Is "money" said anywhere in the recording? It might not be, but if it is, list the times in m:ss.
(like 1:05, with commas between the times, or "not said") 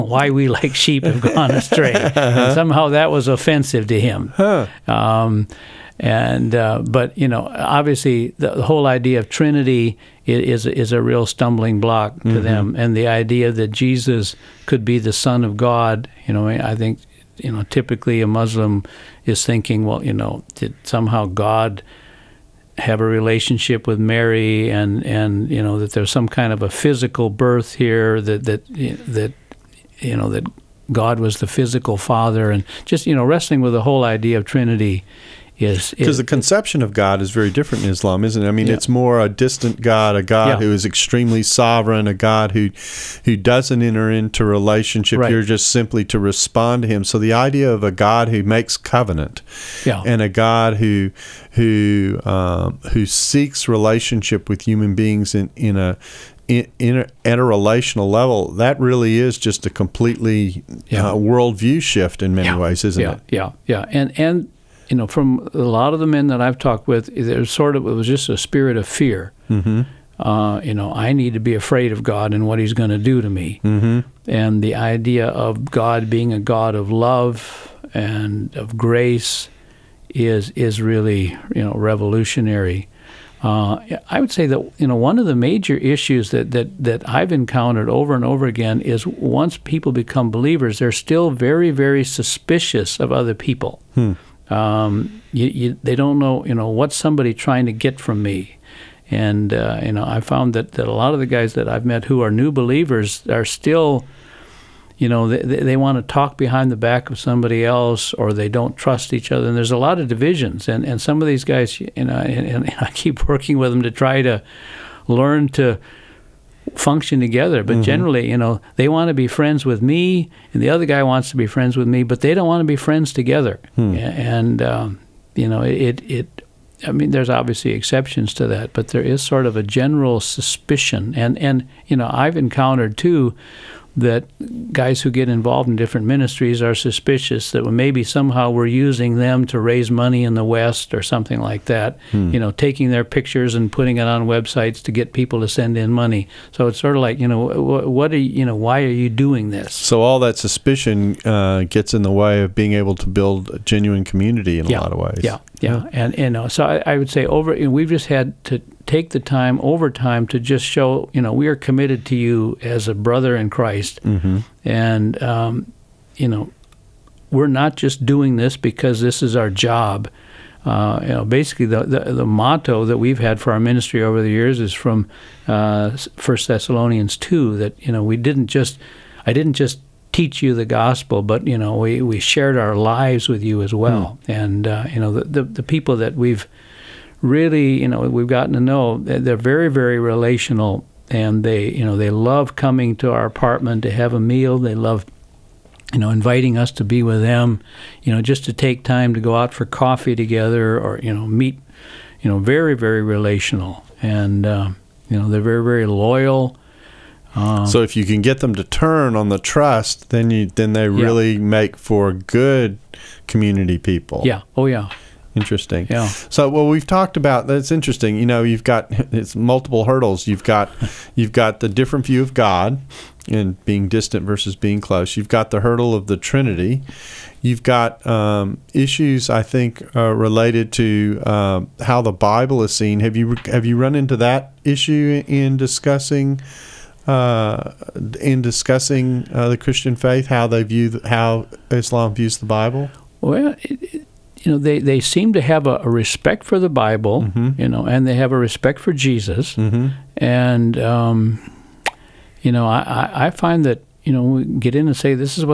2:19, 2:25.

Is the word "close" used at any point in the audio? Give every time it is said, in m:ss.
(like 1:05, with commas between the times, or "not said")
3:44.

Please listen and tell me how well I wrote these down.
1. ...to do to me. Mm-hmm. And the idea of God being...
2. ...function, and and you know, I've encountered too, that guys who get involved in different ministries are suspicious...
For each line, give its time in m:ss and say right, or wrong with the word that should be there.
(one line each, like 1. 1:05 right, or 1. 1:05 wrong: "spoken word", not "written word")
1. 1:12 right
2. 2:10 wrong: "suspicion", not "function".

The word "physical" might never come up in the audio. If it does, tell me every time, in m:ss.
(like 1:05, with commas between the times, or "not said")
0:26, 0:31.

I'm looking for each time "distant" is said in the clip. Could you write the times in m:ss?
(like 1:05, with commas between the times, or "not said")
0:39, 3:43.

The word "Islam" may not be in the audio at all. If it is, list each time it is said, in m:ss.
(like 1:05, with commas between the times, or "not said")
0:37, 4:01.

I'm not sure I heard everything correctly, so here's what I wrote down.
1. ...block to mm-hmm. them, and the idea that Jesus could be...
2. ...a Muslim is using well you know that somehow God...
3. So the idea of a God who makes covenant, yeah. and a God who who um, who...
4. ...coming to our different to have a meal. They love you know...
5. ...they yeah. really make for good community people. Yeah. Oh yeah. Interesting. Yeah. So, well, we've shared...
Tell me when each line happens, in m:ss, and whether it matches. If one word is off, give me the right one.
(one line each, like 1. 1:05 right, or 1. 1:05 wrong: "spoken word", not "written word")
1. 0:11 right
2. 0:18 wrong: "thinking", not "using"
3. 0:47 right
4. 3:12 wrong: "apartment", not "different"
5. 3:30 wrong: "talked", not "shared".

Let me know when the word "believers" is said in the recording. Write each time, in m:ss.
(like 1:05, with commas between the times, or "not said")
1:30, 1:42.